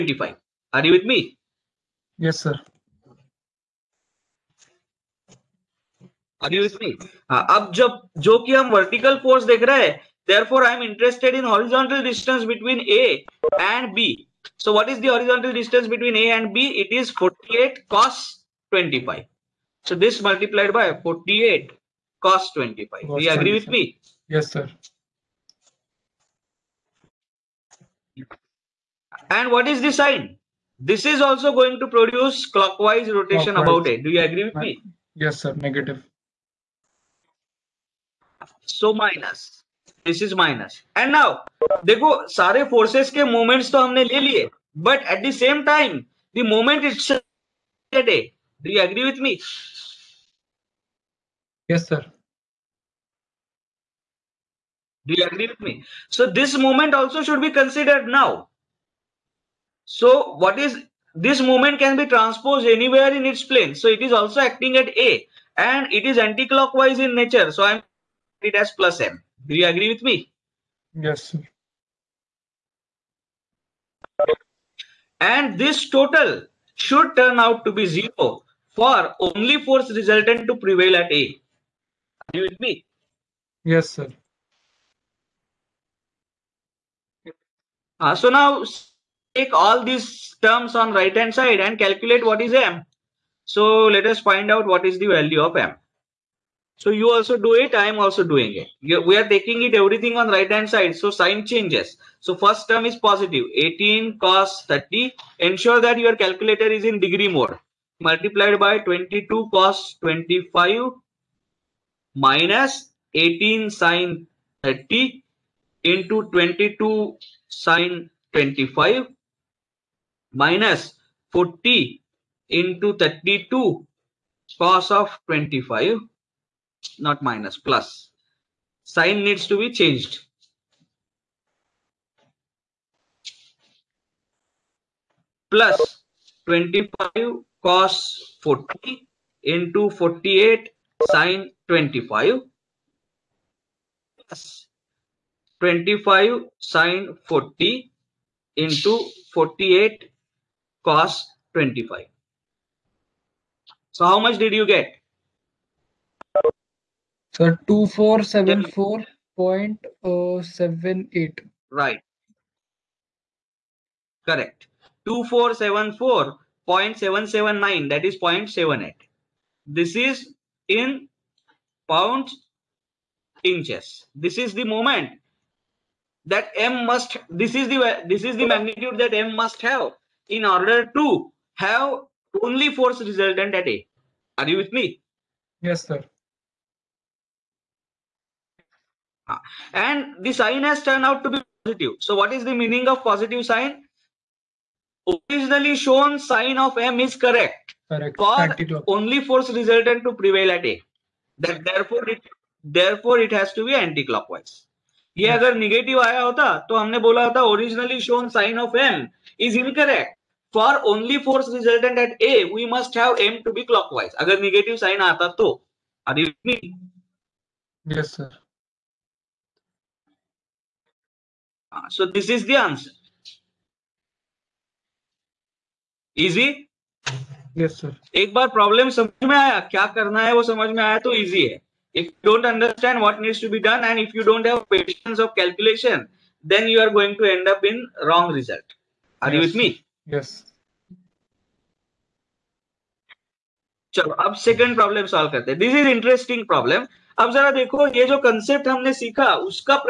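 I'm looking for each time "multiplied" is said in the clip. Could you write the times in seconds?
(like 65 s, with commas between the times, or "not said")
20 s, 108 s.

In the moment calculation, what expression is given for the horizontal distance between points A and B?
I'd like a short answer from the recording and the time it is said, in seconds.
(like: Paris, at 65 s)
48 cos 25, at 16 s.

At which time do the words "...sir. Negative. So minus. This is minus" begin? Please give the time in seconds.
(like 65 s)
35 s.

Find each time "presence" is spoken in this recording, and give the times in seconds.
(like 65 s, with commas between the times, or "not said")
not said.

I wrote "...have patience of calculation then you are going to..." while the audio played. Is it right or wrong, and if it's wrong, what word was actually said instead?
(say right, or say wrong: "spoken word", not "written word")
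right.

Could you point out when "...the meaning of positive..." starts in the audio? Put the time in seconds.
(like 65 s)
192 s.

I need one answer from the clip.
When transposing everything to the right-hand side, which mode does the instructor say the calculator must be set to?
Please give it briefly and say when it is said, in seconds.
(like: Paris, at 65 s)
degree mode, at 106 s.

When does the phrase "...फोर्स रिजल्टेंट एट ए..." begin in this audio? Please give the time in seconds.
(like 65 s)
211 s.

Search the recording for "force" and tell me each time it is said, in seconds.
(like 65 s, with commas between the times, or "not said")
9 s, 79 s, 182 s, 199 s.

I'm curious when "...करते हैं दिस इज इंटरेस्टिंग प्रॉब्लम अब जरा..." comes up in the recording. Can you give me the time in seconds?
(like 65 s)
245 s.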